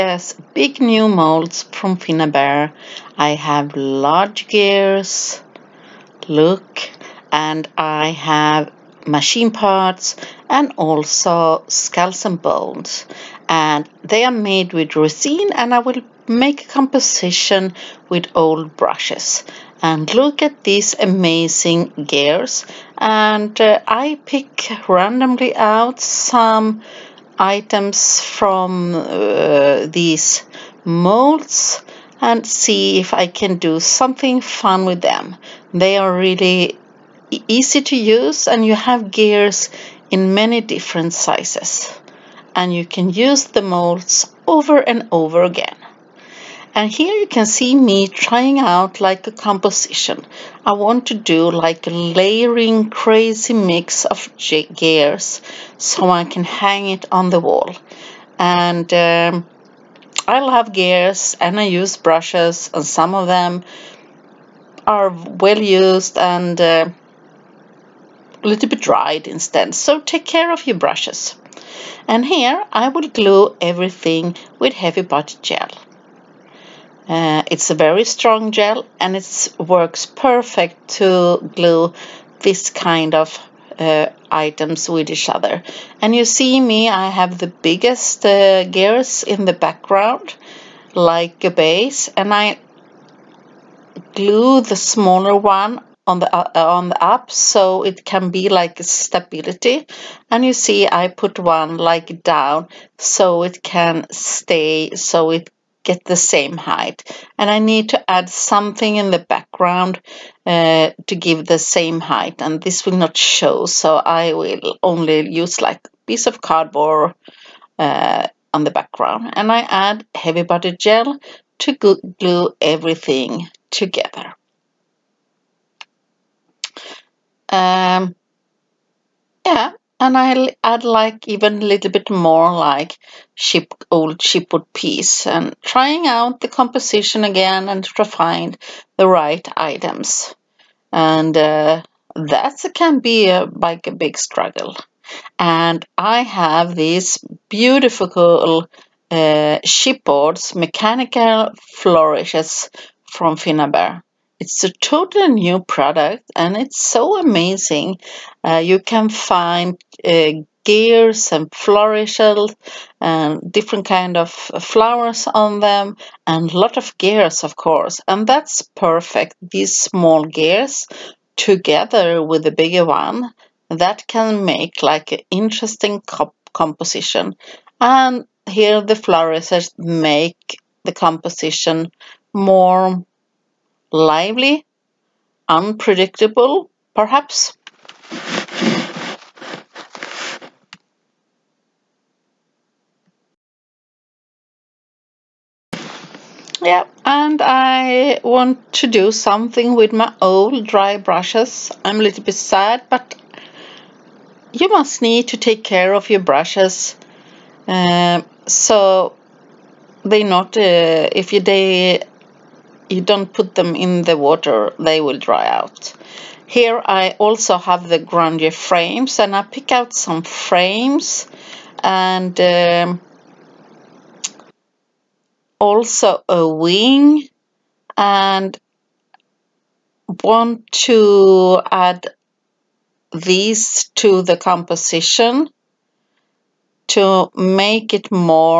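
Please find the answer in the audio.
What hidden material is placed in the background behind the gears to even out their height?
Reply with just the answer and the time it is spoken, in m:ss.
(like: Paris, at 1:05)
Cardboard, at 1:56.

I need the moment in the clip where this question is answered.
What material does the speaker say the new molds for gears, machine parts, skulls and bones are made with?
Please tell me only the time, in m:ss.
0:14.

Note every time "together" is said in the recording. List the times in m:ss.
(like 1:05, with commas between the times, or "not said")
2:03, 2:51.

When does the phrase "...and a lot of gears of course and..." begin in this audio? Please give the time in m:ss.
2:46.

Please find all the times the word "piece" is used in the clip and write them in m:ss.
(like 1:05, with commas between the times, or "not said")
1:56, 2:14.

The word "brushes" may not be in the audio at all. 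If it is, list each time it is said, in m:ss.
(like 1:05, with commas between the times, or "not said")
0:18, 1:01, 1:10, 3:20, 3:26.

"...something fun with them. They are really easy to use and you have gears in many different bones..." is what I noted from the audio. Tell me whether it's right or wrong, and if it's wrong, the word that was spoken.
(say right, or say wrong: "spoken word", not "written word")
wrong: "sizes", not "bones".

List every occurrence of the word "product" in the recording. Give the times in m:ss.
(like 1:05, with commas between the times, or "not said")
2:35.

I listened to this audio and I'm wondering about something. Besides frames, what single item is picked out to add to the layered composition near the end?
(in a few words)
A wing.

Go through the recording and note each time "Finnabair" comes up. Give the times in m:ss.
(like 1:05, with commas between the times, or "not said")
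0:01, 2:33.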